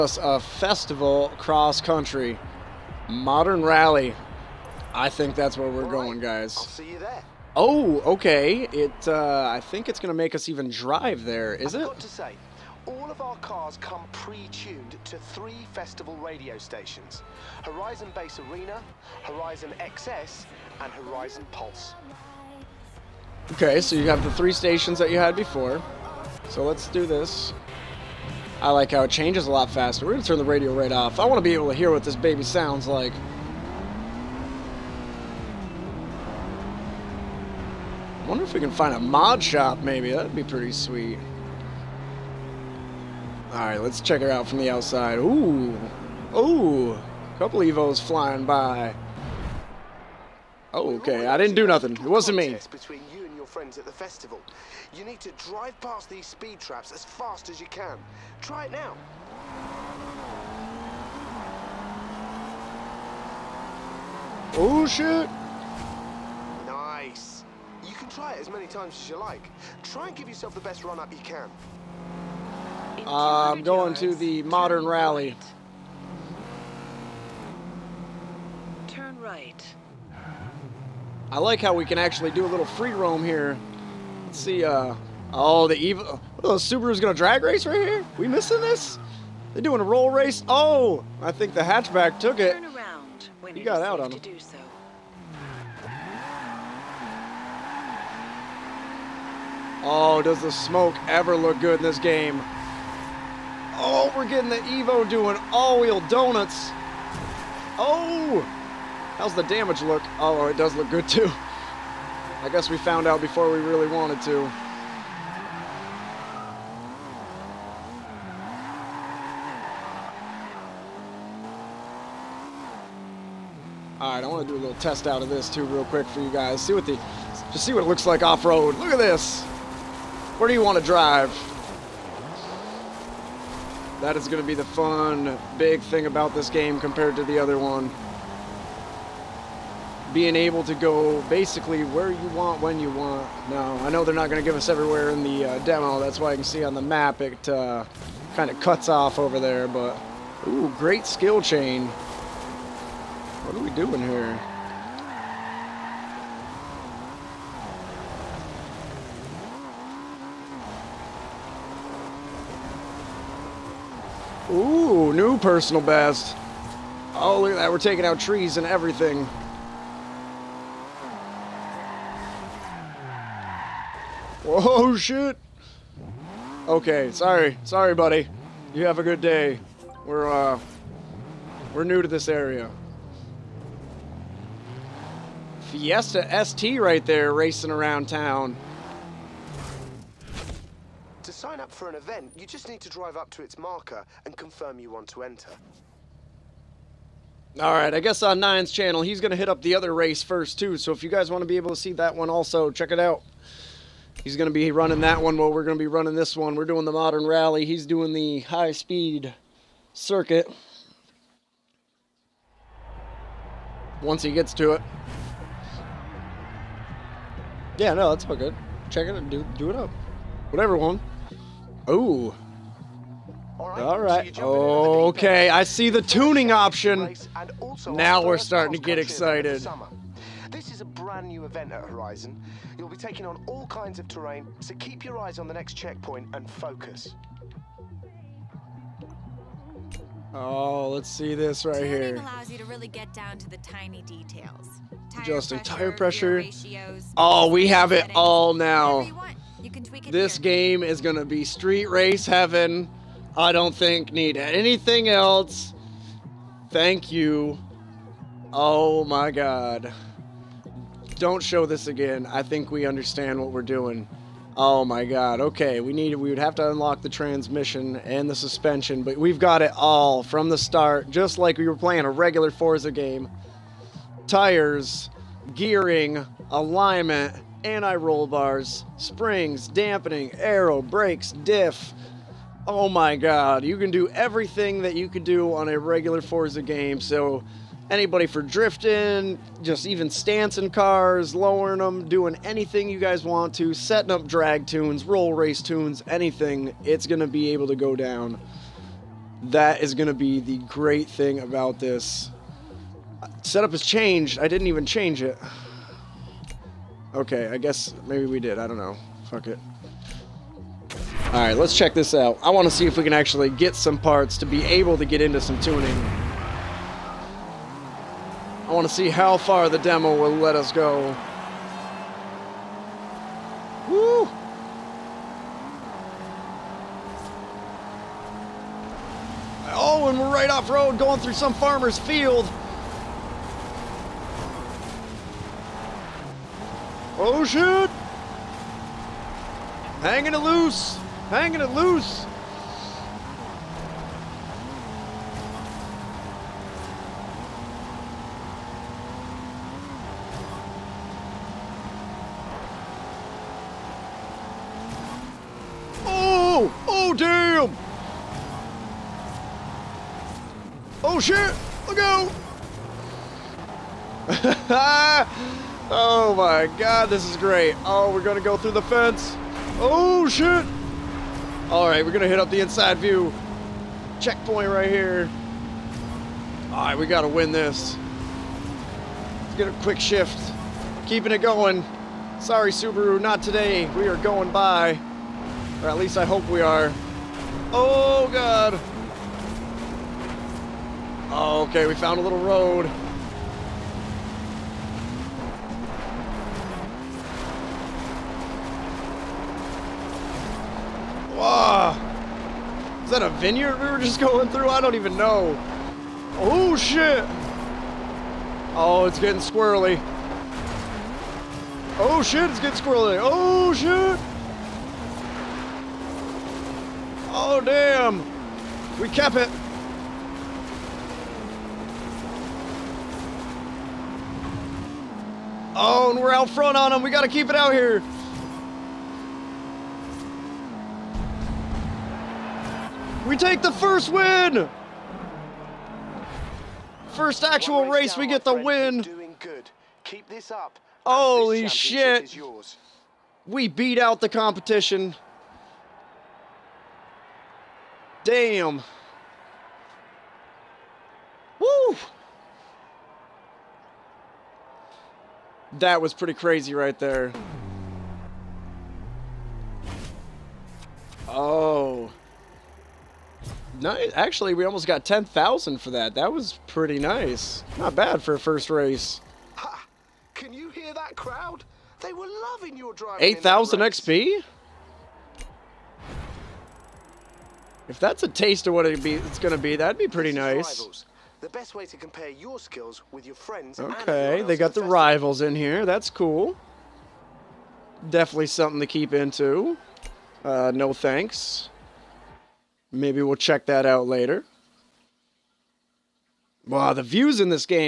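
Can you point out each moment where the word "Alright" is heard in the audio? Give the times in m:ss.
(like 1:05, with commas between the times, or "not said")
2:04, 5:11, 6:11, 6:16.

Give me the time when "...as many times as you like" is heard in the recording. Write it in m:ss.
1:08.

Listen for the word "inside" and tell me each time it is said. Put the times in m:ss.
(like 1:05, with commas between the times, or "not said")
6:12.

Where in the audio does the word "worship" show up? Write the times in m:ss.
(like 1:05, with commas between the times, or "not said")
not said.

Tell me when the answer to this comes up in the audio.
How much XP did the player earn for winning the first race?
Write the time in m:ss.
7:53.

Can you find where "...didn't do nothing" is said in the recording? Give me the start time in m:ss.
0:51.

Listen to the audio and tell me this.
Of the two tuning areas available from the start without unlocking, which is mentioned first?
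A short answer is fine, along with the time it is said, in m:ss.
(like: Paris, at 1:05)
Transmission, at 4:27.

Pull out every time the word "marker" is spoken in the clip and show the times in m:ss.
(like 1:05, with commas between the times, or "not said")
3:13.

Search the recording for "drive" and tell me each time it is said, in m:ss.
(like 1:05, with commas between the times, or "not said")
0:10, 0:55, 2:10, 3:12.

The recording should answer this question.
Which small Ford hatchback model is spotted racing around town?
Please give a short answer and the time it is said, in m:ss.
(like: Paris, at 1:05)
Fiesta ST, at 3:05.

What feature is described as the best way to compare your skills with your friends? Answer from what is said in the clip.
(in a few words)
Rivals.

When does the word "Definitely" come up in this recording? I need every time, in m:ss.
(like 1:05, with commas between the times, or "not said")
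8:08.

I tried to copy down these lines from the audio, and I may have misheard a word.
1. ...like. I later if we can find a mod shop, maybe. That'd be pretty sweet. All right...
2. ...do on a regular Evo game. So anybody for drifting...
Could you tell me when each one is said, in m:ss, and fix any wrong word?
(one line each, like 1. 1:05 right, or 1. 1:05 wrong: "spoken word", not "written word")
1. 0:32 wrong: "wonder", not "later"
2. 4:45 wrong: "Forza", not "Evo".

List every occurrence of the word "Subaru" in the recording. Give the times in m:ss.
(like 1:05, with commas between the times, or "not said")
1:26, 6:22.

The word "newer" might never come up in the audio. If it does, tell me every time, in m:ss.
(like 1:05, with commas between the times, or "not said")
not said.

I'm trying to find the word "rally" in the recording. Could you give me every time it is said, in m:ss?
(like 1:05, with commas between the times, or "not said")
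0:03, 1:14, 3:27.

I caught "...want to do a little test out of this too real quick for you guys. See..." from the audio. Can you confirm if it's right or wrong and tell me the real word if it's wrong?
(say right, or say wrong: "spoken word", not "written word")
right.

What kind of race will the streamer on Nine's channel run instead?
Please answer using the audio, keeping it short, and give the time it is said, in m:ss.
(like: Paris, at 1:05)
High-speed circuit, at 3:28.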